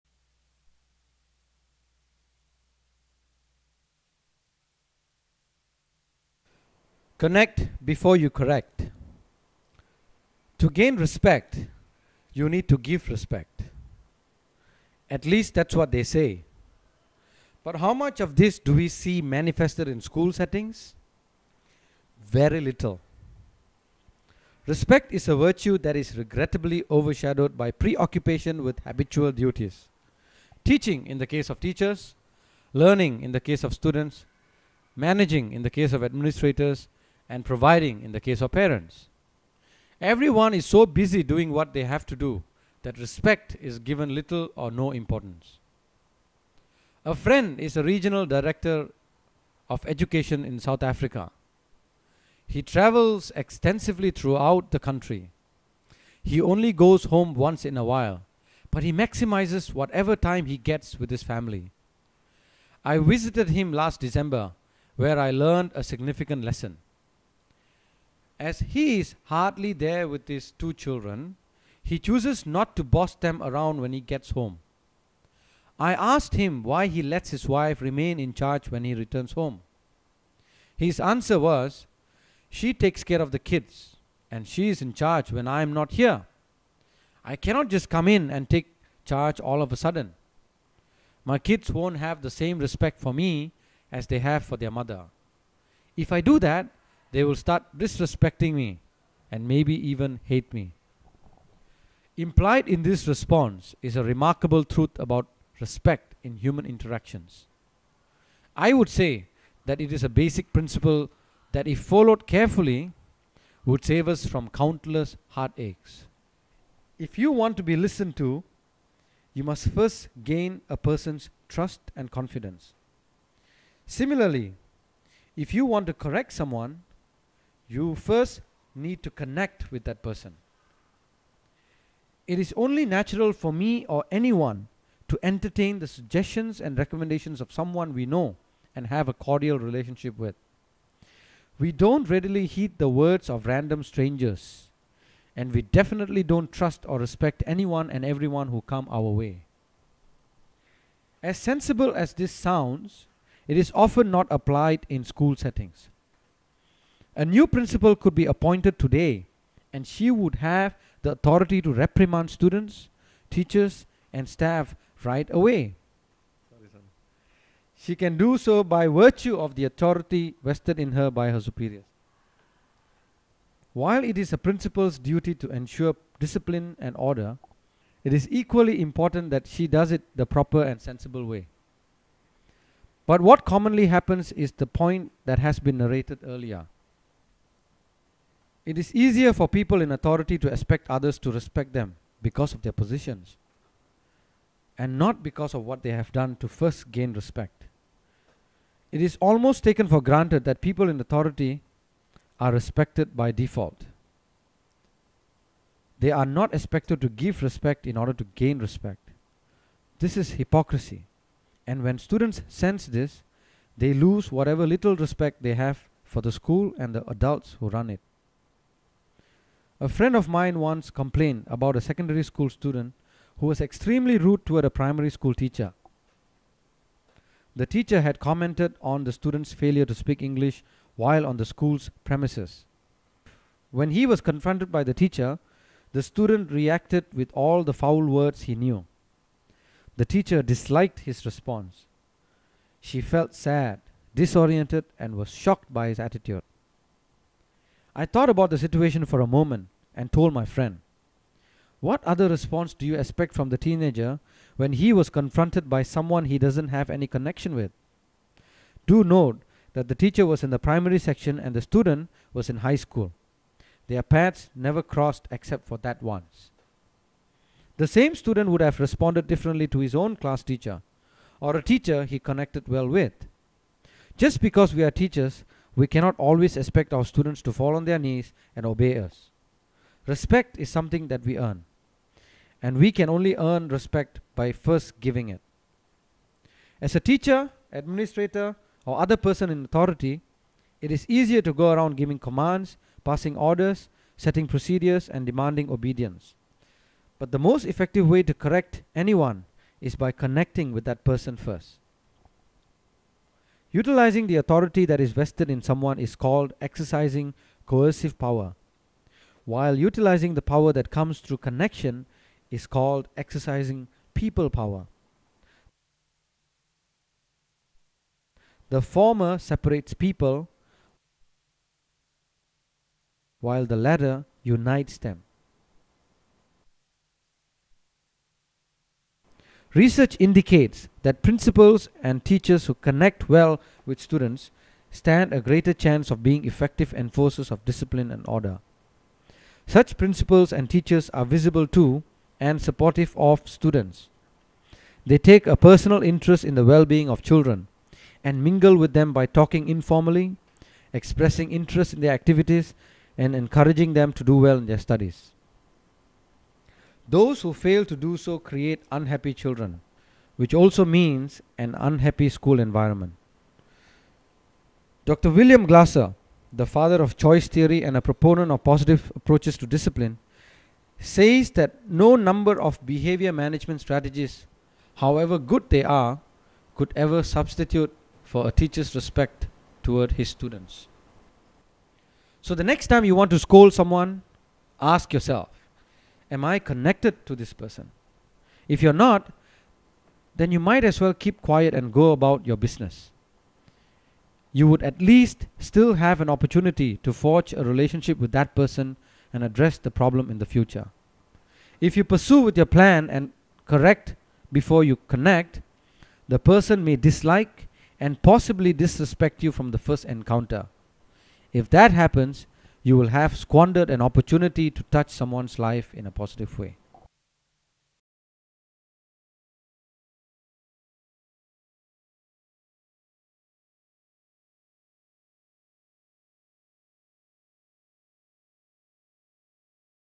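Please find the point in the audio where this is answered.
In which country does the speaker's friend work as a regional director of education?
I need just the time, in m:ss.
0:50.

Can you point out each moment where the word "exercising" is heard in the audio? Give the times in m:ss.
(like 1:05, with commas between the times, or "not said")
5:06, 5:13.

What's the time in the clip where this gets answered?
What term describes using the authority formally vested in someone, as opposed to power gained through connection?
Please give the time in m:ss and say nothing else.
5:07.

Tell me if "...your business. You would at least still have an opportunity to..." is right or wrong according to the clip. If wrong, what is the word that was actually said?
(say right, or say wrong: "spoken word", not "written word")
right.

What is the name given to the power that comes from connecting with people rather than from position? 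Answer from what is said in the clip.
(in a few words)
people power.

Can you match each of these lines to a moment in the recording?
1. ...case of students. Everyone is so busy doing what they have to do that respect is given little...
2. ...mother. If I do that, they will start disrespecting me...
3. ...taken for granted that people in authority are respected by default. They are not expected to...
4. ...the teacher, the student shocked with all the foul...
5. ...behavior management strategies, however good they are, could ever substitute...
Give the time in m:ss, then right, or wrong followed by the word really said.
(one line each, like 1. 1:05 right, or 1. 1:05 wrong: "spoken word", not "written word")
1. 0:38 wrong: "parents", not "students"
2. 1:34 right
3. 3:19 right
4. 3:54 wrong: "reacted", not "shocked"
5. 6:12 right.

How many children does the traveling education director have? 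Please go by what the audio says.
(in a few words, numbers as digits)
2.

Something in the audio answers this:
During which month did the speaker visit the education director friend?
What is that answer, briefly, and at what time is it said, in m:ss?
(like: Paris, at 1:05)
December, at 1:04.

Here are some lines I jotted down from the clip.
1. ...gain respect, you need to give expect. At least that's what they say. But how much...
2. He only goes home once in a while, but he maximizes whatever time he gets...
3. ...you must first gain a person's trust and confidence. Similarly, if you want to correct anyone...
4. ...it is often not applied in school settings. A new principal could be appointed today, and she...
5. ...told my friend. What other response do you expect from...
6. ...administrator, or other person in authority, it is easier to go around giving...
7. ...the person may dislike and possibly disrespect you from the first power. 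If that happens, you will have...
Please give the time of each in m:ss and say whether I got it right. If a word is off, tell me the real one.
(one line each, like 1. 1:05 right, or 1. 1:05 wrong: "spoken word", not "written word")
1. 0:10 wrong: "respect", not "expect"
2. 0:56 right
3. 1:59 wrong: "someone", not "anyone"
4. 2:33 right
5. 4:10 right
6. 4:47 right
7. 6:46 wrong: "encounter", not "power".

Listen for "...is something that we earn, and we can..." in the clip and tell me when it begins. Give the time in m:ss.
4:40.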